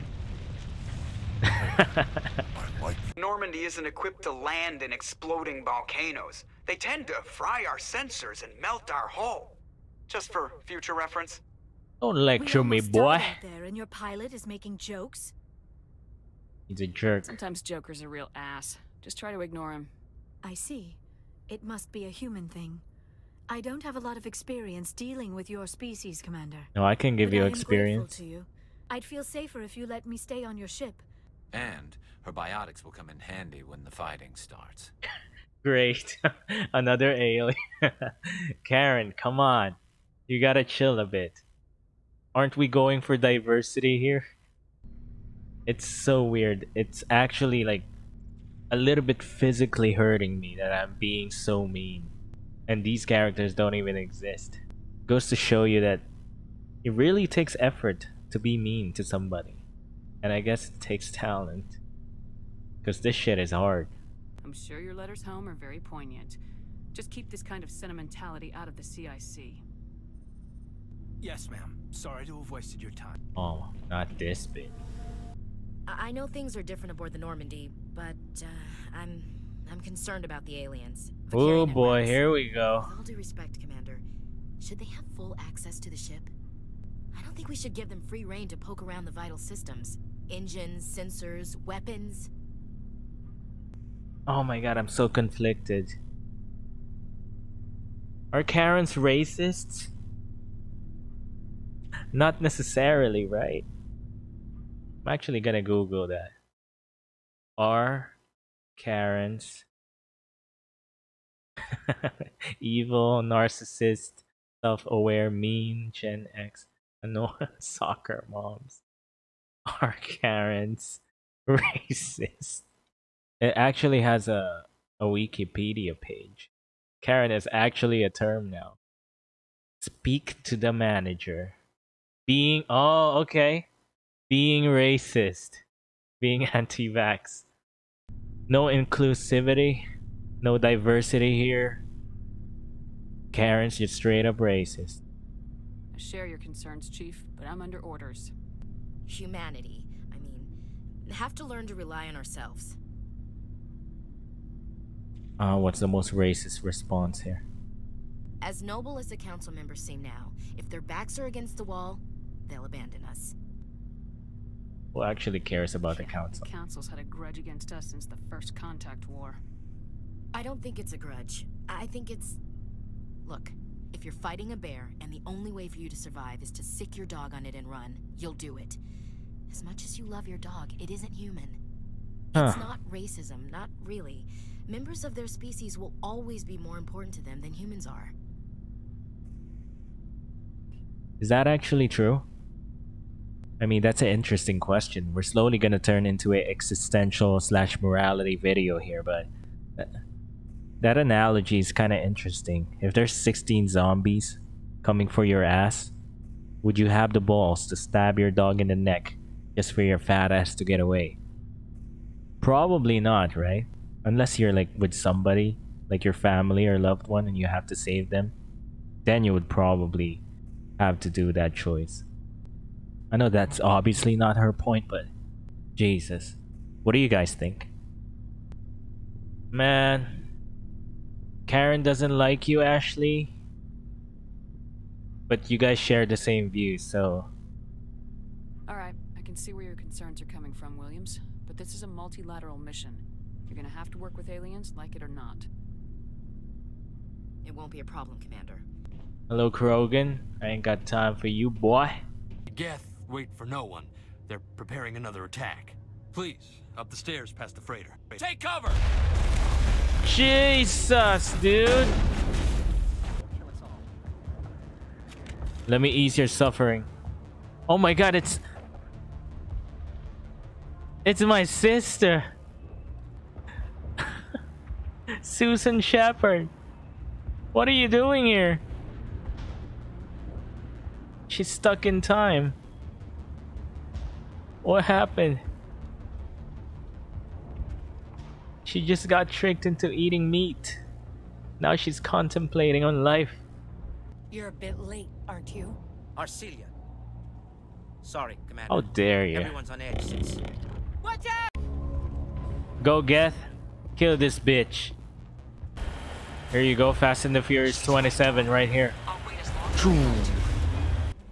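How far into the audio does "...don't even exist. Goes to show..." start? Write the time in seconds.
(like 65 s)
53 s.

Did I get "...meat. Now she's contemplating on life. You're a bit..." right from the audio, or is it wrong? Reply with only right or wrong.
right.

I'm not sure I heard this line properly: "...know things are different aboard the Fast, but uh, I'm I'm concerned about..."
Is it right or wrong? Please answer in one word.
wrong.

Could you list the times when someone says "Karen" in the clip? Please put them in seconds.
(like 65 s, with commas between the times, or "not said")
38 s, 98 s, 108 s, 120 s, 127 s, 143 s, 231 s.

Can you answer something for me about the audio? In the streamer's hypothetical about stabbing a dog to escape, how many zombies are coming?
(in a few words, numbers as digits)
16.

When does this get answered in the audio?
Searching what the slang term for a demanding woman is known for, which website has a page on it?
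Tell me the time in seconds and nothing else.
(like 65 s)
125 s.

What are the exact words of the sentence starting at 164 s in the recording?
Who actually cares about the council?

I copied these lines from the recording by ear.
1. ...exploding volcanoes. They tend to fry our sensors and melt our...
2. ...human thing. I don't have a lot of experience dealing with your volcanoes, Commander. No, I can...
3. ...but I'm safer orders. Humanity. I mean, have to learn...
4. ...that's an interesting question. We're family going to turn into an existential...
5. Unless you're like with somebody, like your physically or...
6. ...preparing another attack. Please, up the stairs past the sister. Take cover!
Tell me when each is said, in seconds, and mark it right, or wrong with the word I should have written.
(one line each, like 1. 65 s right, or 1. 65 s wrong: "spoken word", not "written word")
1. 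4 s right
2. 22 s wrong: "species", not "volcanoes"
3. 147 s wrong: "under", not "safer"
4. 193 s wrong: "slowly", not "family"
5. 214 s wrong: "family", not "physically"
6. 254 s wrong: "freighter", not "sister".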